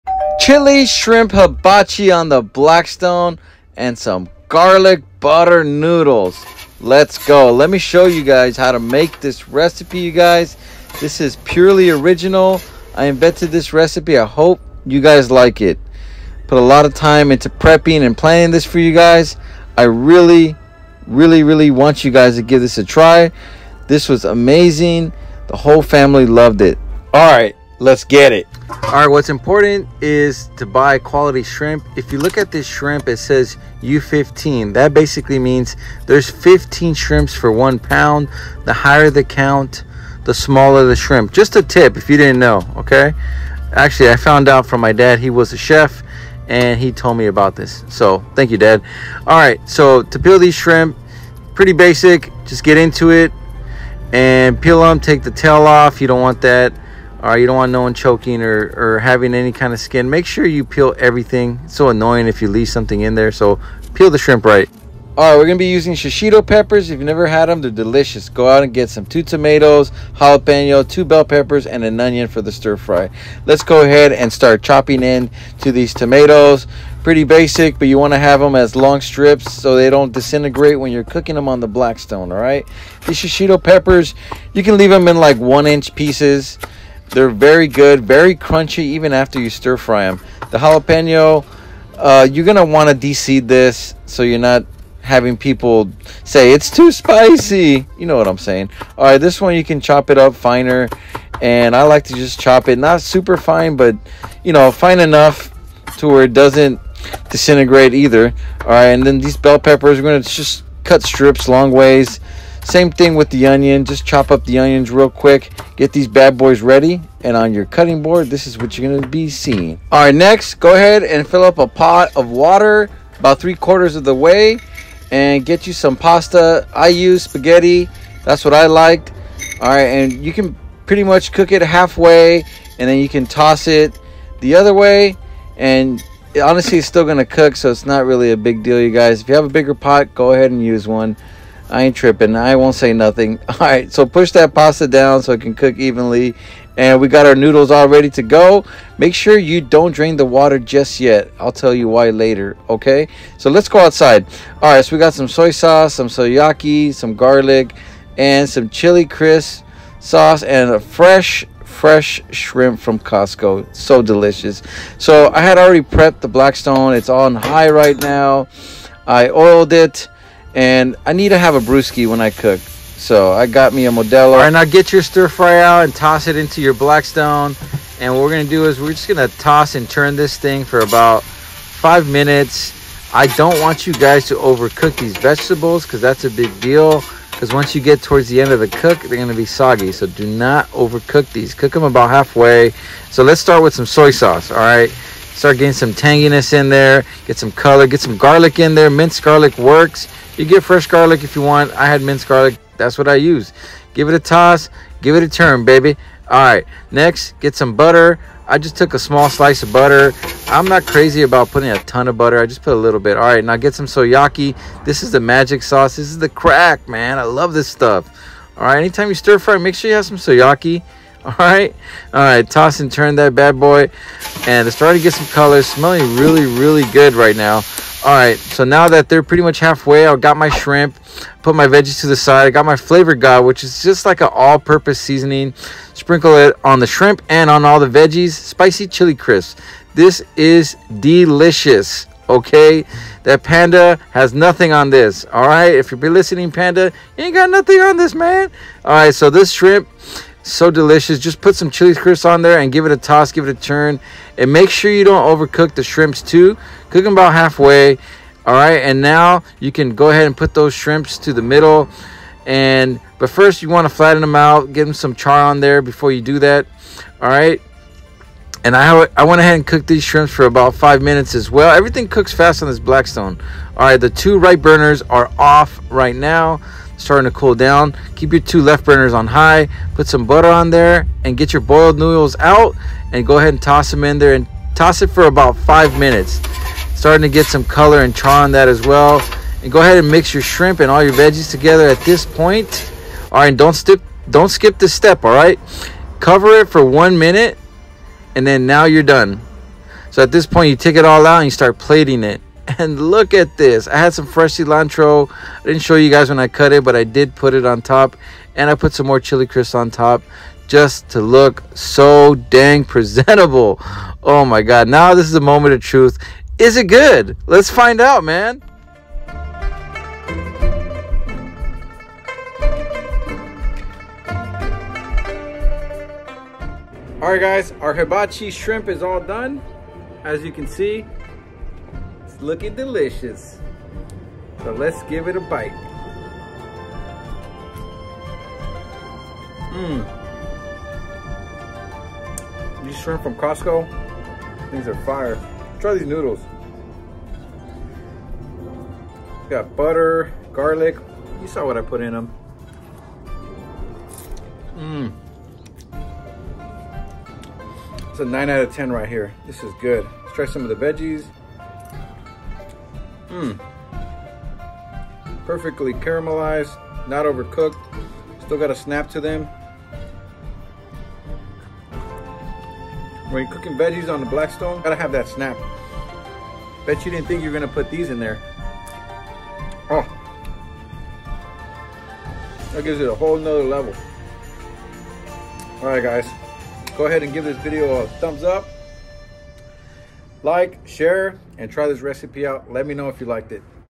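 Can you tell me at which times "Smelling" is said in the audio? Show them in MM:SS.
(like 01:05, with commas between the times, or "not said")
03:45.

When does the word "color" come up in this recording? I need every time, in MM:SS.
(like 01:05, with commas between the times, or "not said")
03:17, 03:45, 04:47.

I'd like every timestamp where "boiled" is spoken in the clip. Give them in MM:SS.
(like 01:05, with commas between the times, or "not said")
04:41.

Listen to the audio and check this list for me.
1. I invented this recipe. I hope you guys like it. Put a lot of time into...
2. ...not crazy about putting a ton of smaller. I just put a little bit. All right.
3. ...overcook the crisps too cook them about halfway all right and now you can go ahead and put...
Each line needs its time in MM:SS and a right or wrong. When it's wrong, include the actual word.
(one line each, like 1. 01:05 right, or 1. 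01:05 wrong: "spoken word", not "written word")
1. 00:12 right
2. 03:30 wrong: "butter", not "smaller"
3. 04:15 wrong: "shrimps", not "crisps".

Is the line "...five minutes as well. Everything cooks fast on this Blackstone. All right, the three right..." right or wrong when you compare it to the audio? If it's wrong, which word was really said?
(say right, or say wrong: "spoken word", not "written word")
wrong: "two", not "three".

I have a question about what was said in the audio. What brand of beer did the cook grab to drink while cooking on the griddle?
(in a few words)
Modelo.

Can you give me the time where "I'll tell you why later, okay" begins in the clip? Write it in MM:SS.
02:31.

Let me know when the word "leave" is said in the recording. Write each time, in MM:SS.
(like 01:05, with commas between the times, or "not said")
01:02, 01:24.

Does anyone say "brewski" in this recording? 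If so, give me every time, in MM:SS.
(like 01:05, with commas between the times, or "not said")
02:51.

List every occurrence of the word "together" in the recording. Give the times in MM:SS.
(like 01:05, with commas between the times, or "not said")
04:51.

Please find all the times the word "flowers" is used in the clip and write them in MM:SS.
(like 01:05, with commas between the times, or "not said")
not said.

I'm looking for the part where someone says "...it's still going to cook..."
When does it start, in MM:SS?
02:16.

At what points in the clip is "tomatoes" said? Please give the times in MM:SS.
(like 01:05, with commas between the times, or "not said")
01:09, 01:15.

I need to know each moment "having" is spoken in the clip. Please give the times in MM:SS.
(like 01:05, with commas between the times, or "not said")
00:58, 01:35.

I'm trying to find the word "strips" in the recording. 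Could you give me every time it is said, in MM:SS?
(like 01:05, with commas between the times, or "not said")
01:18, 01:51.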